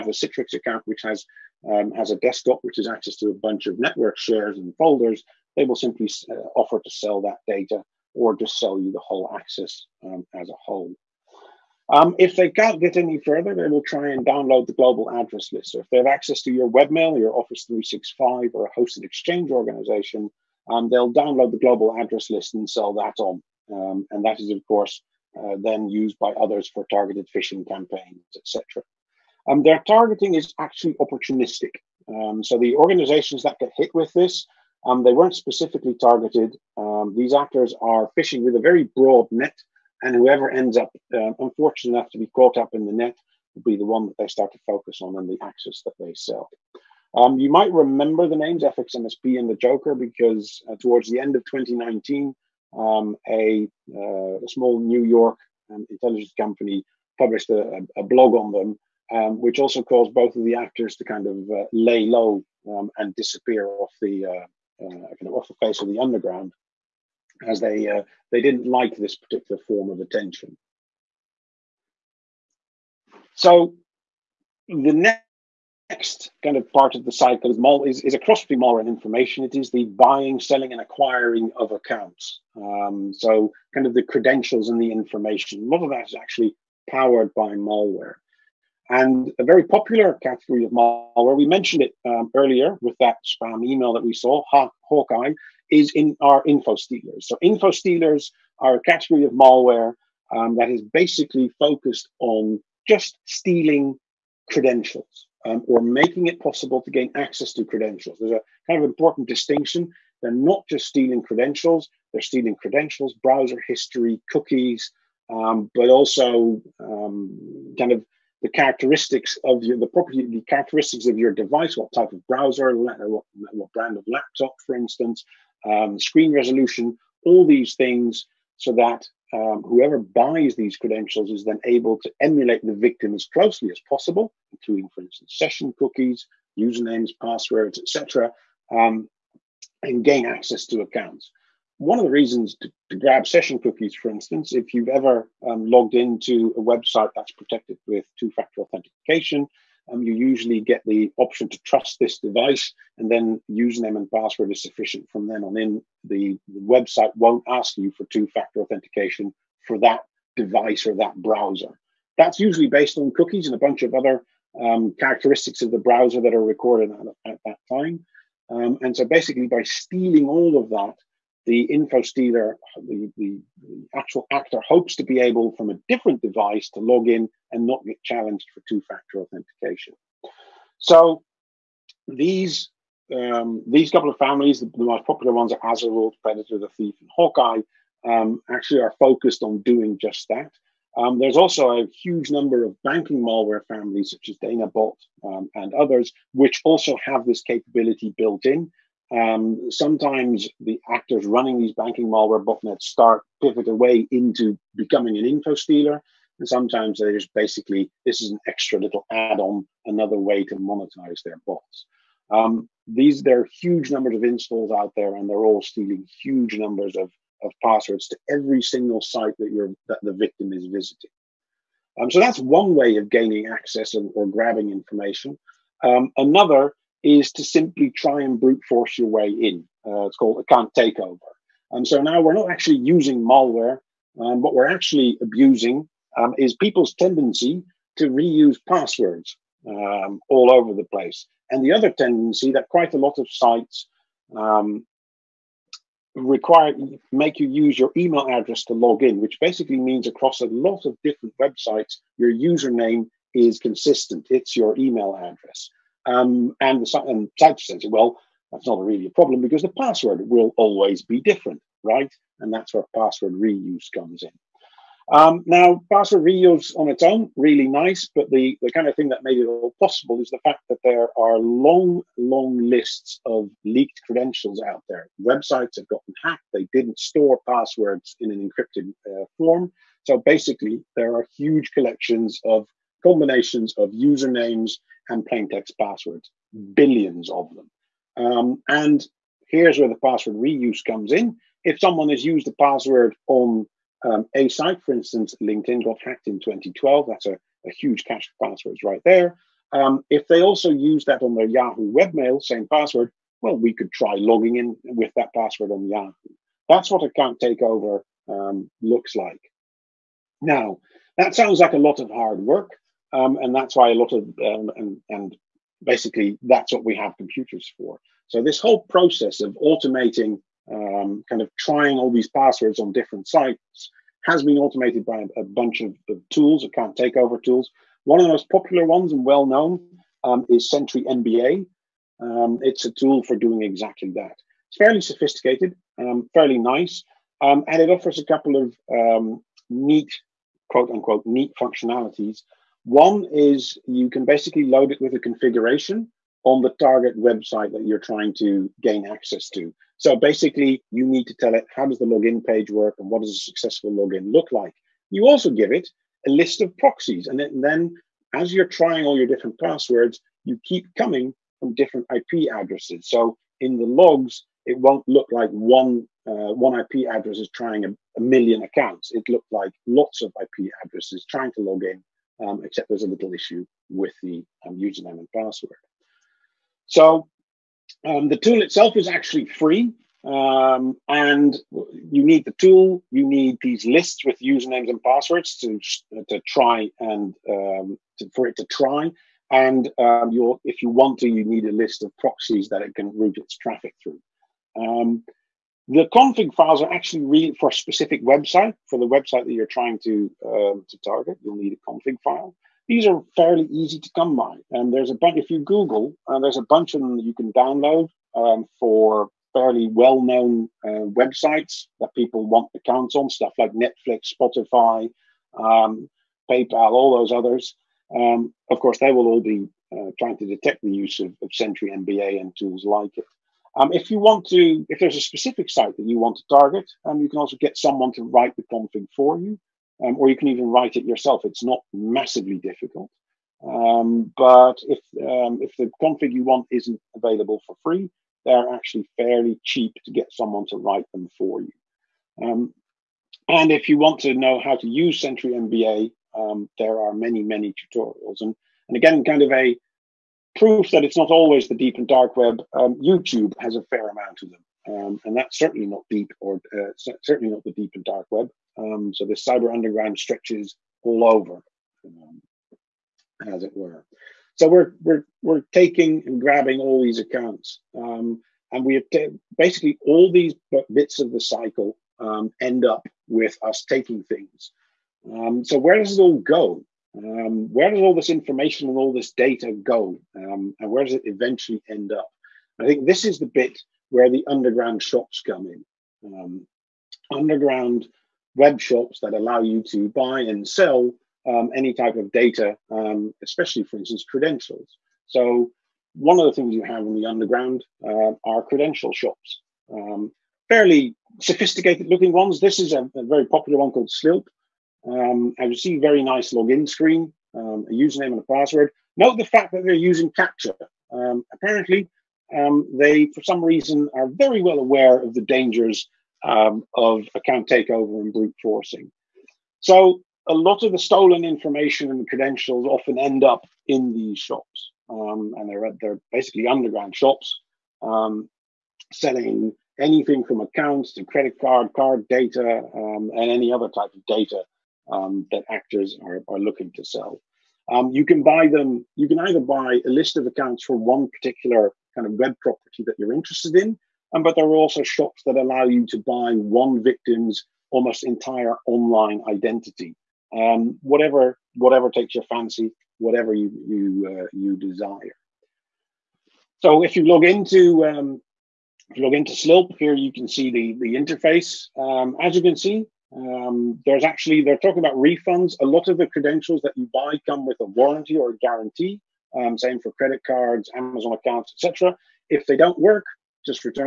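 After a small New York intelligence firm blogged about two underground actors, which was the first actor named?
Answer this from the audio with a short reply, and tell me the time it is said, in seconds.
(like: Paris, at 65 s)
FXMSP, at 48 s.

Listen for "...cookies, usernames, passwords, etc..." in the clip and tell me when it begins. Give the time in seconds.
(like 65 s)
135 s.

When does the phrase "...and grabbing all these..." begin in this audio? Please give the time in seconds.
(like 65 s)
466 s.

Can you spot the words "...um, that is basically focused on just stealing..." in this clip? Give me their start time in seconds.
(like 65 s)
100 s.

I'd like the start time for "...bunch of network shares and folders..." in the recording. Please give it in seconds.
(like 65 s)
3 s.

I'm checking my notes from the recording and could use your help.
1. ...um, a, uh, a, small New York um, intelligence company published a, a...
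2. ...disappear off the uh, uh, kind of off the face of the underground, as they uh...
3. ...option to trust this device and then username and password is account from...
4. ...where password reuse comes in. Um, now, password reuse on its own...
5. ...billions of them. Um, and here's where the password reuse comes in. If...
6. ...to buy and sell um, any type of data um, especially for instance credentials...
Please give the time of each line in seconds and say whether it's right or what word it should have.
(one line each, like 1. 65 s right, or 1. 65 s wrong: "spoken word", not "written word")
1. 52 s right
2. 63 s right
3. 151 s wrong: "sufficient", not "account"
4. 262 s right
5. 286 s right
6. 489 s right.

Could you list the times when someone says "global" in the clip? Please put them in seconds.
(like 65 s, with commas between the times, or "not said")
14 s, 21 s.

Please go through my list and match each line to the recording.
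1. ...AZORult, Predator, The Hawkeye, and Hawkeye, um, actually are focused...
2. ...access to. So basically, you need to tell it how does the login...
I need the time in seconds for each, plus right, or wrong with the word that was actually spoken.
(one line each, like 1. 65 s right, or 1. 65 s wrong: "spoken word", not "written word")
1. 185 s wrong: "Thief", not "Hawkeye"
2. 349 s right.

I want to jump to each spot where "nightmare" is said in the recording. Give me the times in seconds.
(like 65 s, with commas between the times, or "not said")
not said.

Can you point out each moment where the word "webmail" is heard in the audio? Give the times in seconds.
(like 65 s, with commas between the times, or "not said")
16 s, 301 s.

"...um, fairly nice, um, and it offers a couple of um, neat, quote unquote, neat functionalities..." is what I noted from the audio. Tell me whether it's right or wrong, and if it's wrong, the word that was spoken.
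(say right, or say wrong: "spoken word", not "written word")
right.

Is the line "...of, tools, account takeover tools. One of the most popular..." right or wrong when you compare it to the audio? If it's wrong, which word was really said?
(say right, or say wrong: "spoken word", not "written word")
right.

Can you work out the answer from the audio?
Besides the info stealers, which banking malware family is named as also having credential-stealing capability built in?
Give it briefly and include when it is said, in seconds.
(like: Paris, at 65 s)
DanaBot, at 194 s.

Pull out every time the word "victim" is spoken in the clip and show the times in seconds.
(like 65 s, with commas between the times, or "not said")
132 s, 220 s, 547 s.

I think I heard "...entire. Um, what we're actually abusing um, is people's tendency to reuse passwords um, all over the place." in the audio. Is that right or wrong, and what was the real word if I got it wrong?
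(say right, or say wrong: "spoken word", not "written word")
wrong: "malware", not "entire".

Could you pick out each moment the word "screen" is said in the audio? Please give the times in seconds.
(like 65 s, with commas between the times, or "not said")
125 s, 506 s.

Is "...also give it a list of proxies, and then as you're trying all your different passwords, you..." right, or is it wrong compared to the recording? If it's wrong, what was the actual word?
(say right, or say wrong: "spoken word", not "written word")
right.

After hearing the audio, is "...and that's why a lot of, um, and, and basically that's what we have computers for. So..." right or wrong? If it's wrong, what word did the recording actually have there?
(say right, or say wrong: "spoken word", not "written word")
right.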